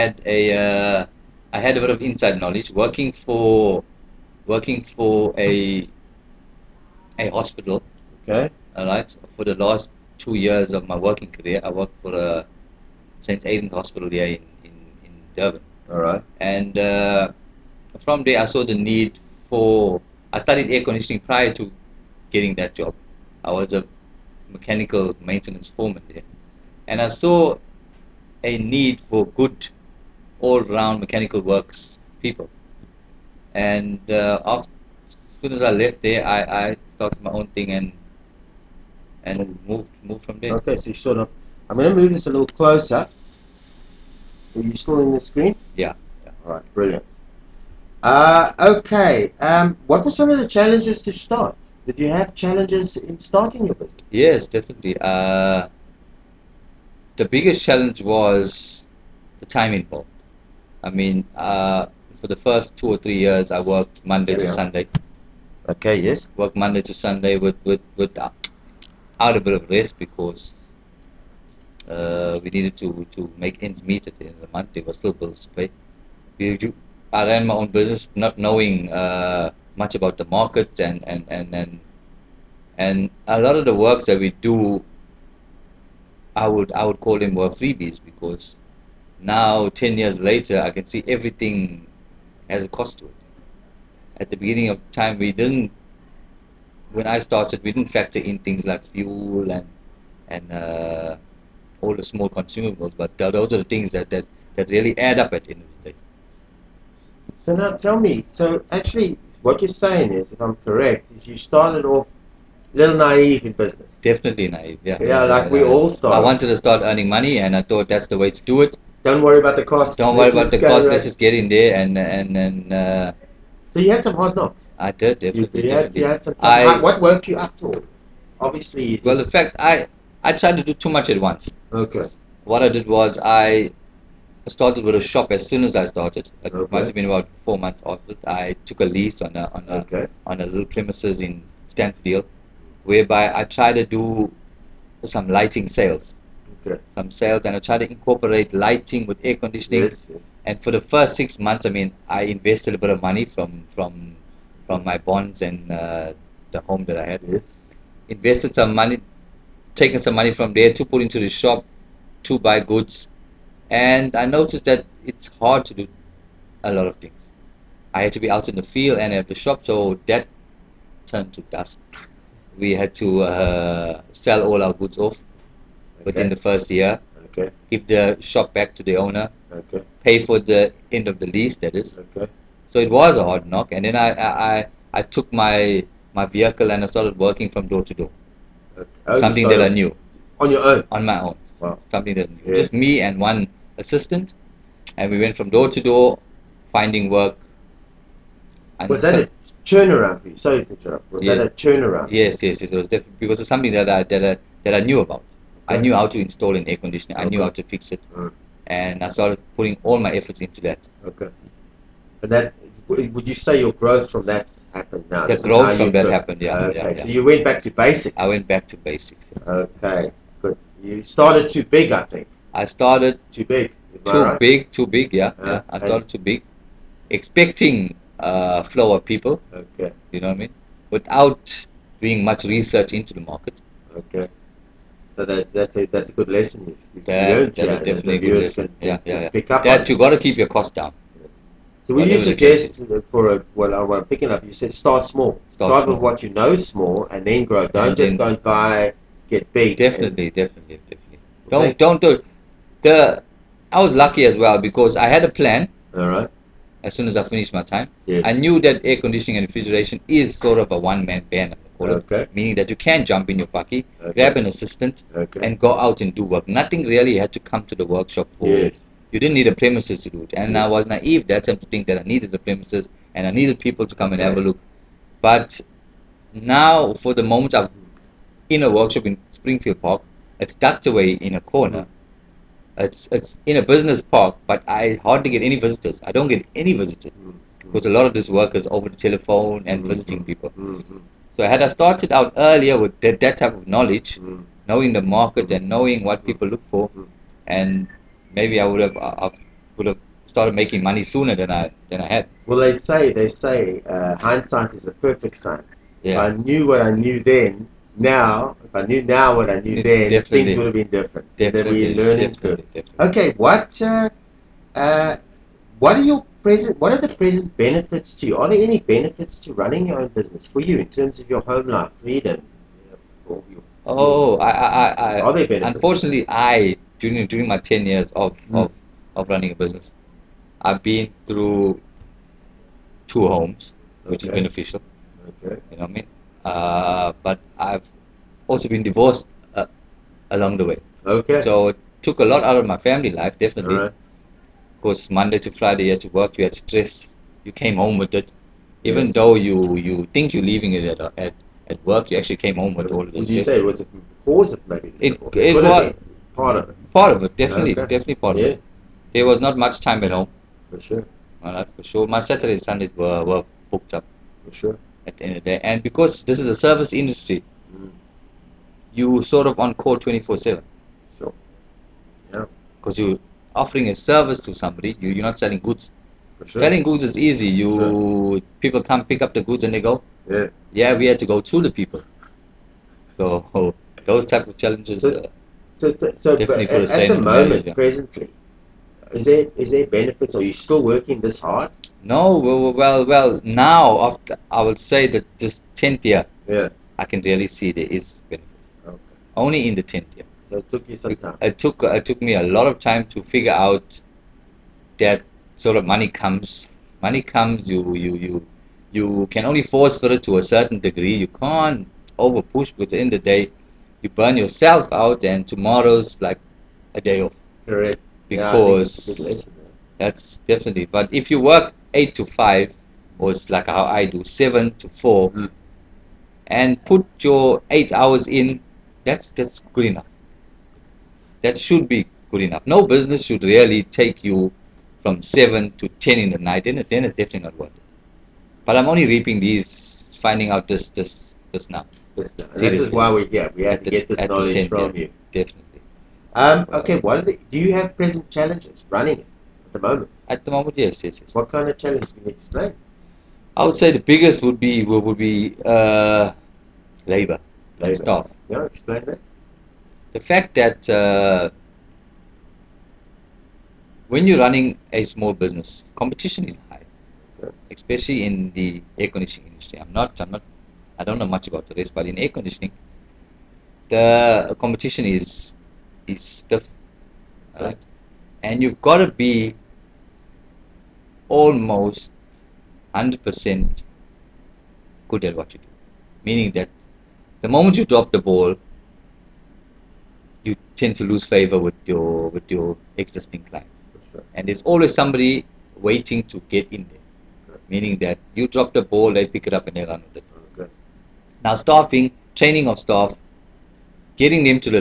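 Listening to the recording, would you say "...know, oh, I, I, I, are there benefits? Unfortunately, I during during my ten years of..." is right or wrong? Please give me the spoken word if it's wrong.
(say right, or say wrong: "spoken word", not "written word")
right.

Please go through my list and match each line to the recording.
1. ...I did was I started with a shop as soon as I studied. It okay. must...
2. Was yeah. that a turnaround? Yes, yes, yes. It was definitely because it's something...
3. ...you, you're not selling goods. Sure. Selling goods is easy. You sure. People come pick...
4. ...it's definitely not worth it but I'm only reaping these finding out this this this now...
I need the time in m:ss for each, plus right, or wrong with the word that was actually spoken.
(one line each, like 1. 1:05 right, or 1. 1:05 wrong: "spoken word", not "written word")
1. 2:12 wrong: "started", not "studied"
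2. 3:21 right
3. 6:15 right
4. 7:17 right.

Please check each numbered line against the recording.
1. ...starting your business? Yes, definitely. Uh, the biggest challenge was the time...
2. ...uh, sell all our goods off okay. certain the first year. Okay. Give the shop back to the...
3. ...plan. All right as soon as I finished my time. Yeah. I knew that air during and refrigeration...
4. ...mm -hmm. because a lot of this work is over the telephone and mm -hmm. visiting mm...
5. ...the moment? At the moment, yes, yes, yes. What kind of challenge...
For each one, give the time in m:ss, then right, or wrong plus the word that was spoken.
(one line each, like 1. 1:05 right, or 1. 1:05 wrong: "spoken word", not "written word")
1. 0:53 right
2. 2:53 wrong: "within", not "certain"
3. 4:15 wrong: "conditioning", not "during"
4. 4:47 right
5. 7:29 right.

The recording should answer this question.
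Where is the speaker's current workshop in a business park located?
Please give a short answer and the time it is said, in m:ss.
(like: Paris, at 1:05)
Springfield Park, at 4:39.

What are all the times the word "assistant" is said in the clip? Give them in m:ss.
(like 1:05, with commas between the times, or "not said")
3:13, 4:24.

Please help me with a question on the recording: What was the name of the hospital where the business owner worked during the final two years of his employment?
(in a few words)
St. Aidan's Hospital.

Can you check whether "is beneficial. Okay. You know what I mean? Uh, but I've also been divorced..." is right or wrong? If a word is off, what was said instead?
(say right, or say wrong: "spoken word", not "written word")
right.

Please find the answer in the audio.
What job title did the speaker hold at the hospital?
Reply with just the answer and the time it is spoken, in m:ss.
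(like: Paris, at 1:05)
mechanical maintenance foreman, at 0:24.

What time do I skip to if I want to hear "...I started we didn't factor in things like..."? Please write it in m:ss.
1:37.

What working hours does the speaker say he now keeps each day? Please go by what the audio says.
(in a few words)
7 to 4.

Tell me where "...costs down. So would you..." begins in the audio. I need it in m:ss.
4:00.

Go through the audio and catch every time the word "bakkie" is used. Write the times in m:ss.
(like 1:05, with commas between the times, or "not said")
4:23.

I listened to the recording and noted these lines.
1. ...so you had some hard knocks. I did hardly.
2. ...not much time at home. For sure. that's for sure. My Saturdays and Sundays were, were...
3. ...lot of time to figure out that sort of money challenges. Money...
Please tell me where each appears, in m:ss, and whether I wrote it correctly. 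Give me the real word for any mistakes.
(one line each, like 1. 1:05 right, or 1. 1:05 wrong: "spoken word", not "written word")
1. 2:03 wrong: "definitely", not "hardly"
2. 5:59 right
3. 6:42 wrong: "comes", not "challenges".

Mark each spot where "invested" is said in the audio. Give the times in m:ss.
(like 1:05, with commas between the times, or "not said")
2:32, 2:38.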